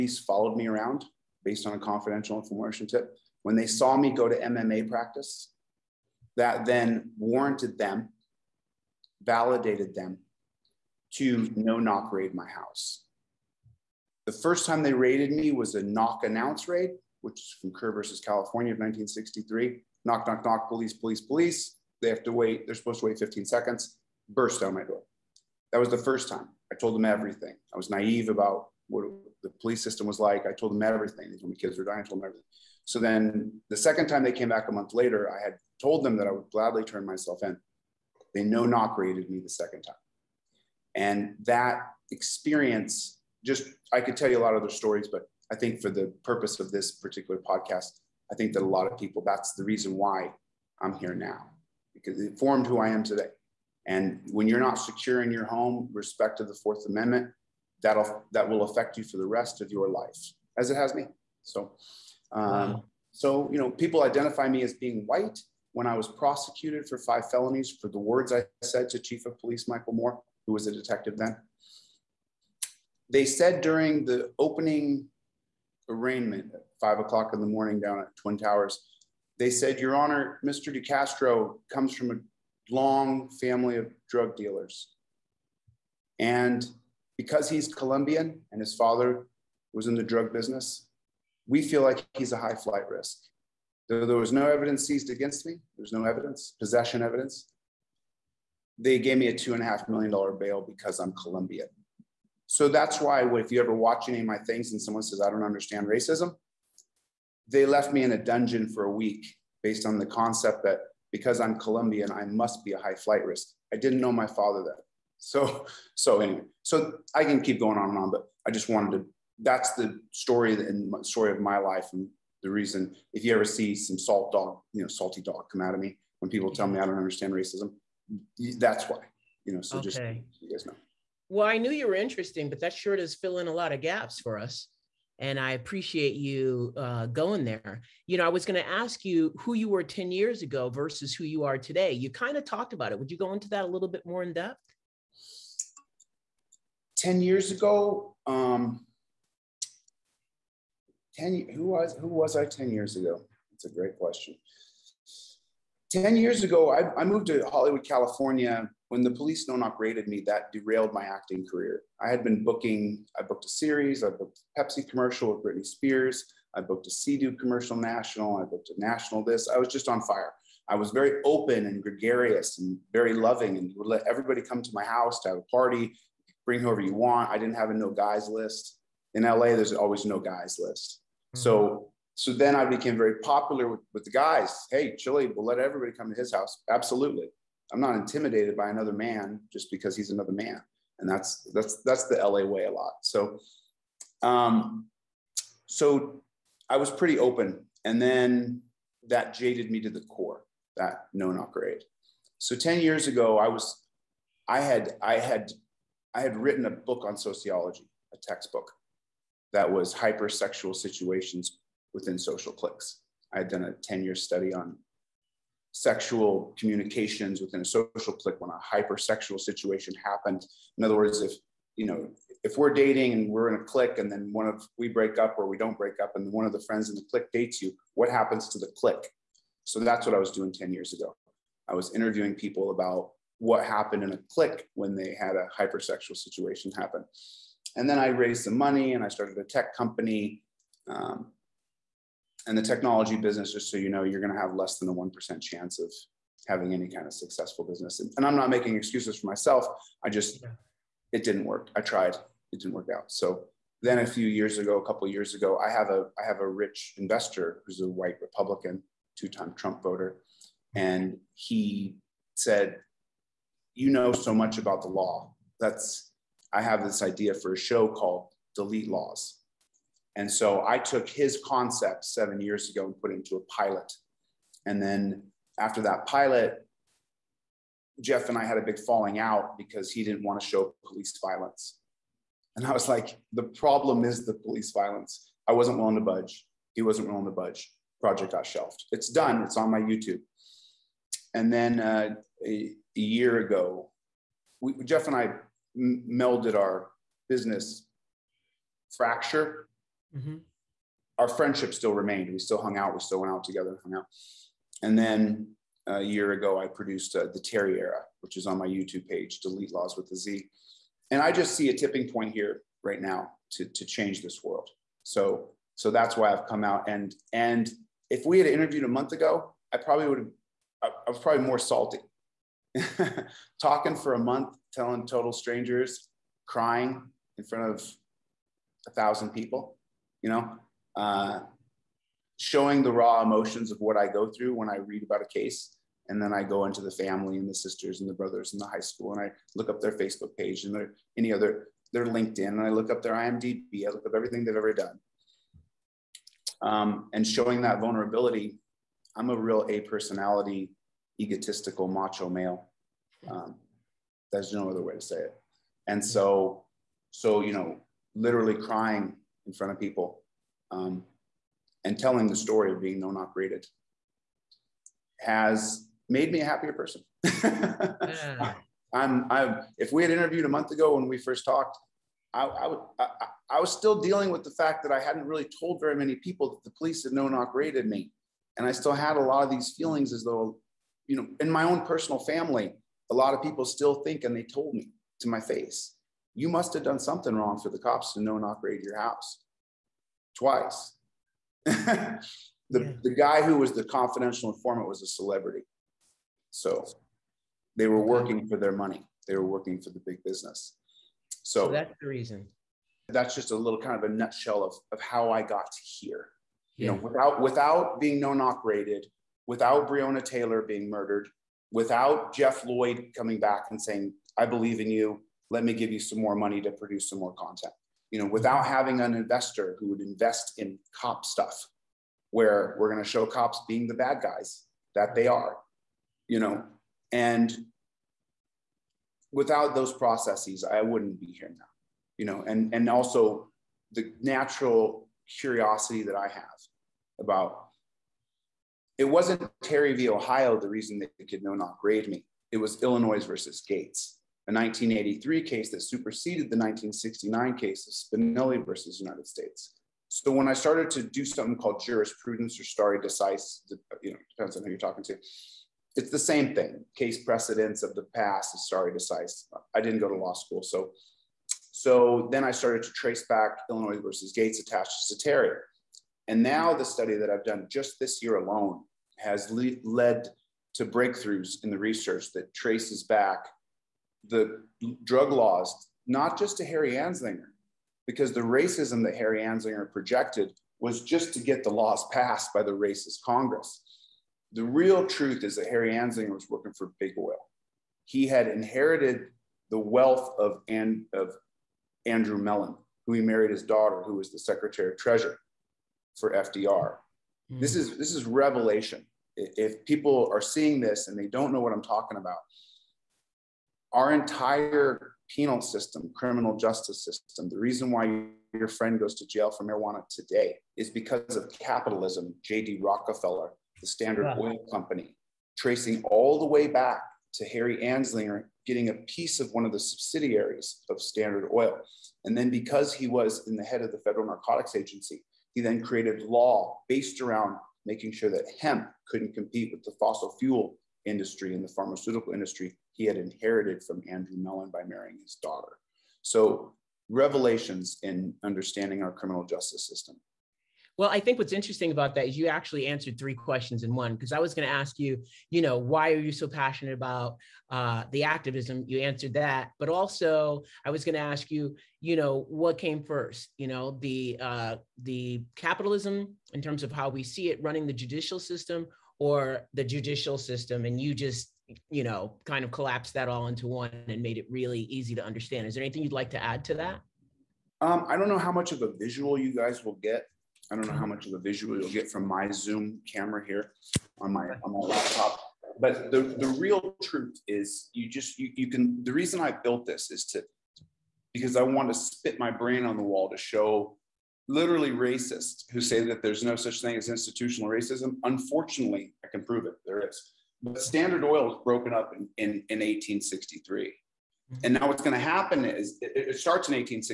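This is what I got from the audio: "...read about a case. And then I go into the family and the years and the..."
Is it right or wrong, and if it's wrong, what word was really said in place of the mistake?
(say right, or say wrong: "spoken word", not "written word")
wrong: "sisters", not "years".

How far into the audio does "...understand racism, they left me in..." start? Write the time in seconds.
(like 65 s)
105 s.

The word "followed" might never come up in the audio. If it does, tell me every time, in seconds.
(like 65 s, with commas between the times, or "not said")
0 s.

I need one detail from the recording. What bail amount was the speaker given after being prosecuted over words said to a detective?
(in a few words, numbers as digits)
$2.5 million.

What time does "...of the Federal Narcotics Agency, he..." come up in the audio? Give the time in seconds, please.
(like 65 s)
523 s.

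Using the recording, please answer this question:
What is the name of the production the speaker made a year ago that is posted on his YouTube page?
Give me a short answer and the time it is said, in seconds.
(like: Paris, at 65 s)
the Terry Era, at 307 s.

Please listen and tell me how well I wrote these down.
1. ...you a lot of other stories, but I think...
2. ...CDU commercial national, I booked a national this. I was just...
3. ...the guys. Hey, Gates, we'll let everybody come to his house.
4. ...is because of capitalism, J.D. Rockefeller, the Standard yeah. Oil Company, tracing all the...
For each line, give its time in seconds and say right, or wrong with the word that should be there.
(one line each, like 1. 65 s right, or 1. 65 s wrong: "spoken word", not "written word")
1. 44 s right
2. 166 s right
3. 184 s wrong: "Chille", not "Gates"
4. 510 s right.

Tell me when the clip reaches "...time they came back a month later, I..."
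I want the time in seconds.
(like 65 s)
34 s.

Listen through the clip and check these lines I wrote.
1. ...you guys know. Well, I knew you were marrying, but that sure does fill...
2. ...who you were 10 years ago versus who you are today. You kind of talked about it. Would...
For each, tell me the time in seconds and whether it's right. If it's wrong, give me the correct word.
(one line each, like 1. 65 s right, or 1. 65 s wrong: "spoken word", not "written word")
1. 130 s wrong: "interesting", not "marrying"
2. 139 s right.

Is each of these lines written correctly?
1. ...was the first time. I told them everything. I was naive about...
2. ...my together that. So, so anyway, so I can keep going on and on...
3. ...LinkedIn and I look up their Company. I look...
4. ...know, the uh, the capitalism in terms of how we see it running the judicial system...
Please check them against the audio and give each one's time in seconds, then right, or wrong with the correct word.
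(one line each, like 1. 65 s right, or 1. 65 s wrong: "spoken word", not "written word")
1. 25 s right
2. 114 s wrong: "father", not "together"
3. 342 s wrong: "IMDb", not "Company"
4. 553 s right.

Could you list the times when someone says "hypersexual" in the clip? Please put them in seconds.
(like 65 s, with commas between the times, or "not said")
209 s, 218 s, 235 s.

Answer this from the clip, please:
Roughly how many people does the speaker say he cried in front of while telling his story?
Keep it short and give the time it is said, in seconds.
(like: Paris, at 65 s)
1,000, at 328 s.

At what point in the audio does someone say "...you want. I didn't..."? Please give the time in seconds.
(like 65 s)
176 s.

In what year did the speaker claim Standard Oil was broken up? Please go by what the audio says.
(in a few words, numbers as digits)
1863.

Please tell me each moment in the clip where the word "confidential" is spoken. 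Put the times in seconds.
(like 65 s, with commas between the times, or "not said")
1 s, 393 s.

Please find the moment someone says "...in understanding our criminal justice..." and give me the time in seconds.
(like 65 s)
538 s.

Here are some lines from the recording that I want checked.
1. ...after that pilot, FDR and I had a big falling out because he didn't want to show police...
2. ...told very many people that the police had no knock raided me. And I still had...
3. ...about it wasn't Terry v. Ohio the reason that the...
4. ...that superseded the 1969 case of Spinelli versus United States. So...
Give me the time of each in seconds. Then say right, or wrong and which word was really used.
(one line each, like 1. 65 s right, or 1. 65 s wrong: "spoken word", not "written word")
1. 275 s wrong: "Jeff", not "FDR"
2. 375 s right
3. 437 s right
4. 445 s right.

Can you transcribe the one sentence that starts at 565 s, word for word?
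Is there anything you'd like to add to that?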